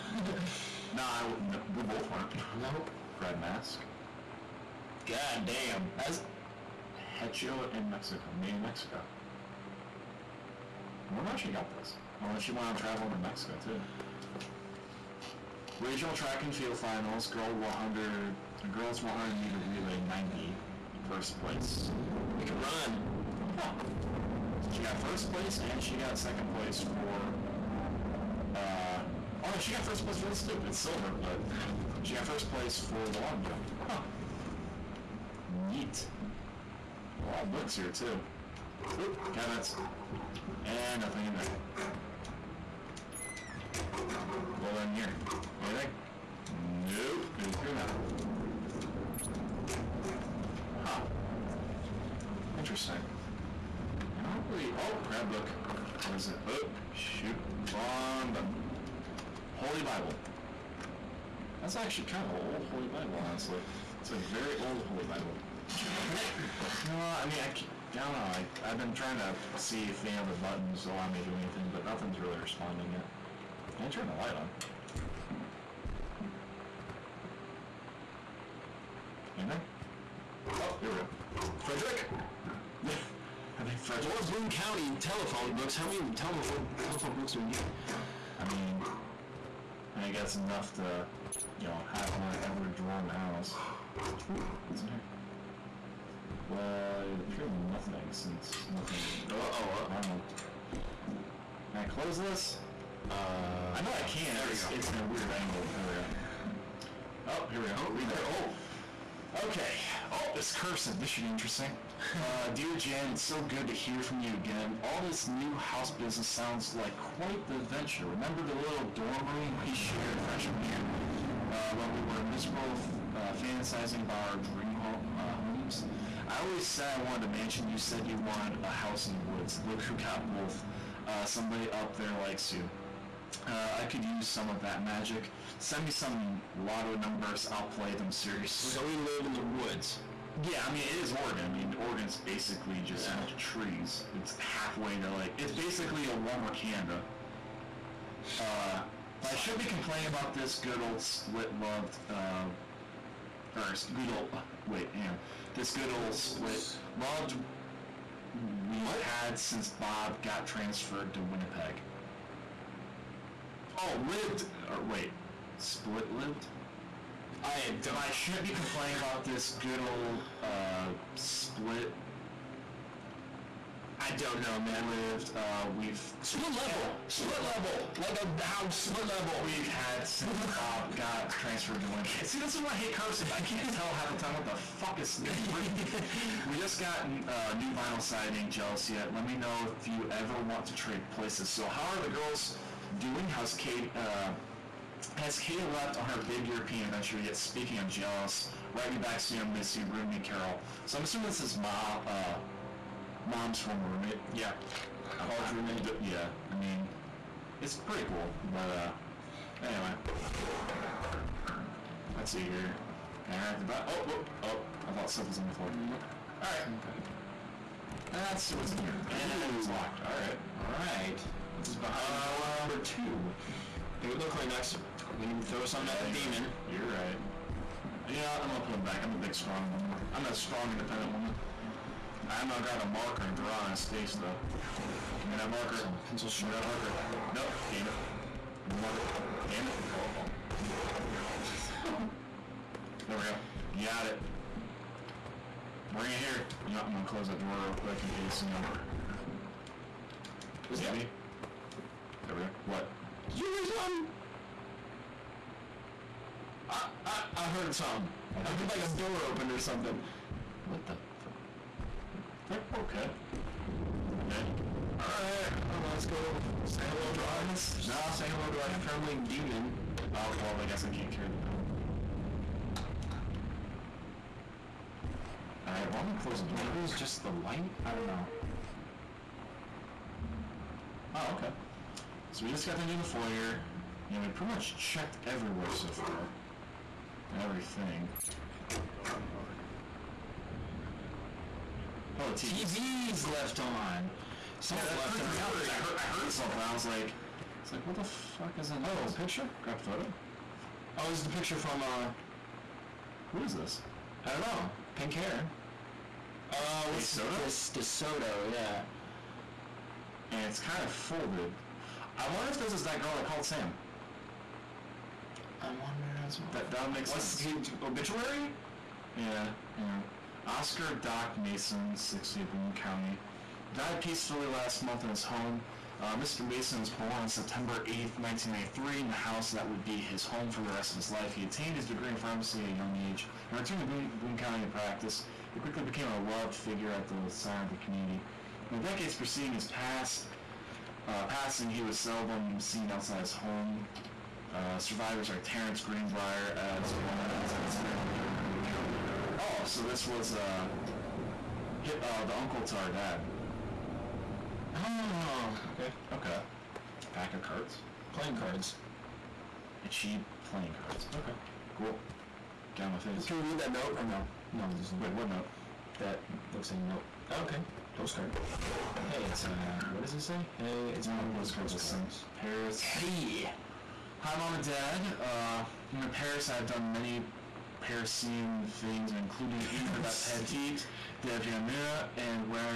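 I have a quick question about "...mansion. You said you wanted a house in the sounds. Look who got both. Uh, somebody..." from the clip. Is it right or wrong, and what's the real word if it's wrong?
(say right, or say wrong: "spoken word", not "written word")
wrong: "woods", not "sounds".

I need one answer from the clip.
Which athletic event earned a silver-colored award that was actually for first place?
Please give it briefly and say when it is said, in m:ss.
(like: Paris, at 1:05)
long jump, at 0:33.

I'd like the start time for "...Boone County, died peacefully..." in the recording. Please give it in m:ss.
5:22.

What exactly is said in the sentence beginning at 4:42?
So we just got done doing the foyer.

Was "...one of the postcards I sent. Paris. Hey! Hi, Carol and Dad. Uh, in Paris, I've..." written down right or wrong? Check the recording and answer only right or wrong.
wrong.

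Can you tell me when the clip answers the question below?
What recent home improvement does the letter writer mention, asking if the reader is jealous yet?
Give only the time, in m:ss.
3:07.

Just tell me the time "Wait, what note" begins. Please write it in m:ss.
6:05.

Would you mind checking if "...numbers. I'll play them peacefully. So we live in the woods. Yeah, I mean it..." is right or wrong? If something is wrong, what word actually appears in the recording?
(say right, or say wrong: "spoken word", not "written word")
wrong: "seriously", not "peacefully".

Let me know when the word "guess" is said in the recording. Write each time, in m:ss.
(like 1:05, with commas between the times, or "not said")
1:30, 4:30.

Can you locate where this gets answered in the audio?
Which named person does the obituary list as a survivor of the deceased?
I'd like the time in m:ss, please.
5:45.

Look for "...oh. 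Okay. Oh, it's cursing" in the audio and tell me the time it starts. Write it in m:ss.
1:49.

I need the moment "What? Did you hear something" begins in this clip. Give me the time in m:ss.
4:12.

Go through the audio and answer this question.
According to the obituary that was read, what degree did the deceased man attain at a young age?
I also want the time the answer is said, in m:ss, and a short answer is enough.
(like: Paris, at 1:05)
pharmacy, at 5:32.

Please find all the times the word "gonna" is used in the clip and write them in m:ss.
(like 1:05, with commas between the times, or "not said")
3:48, 3:52, 4:06, 4:36.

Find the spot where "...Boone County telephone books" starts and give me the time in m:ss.
1:24.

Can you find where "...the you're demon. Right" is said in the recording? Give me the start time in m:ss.
3:46.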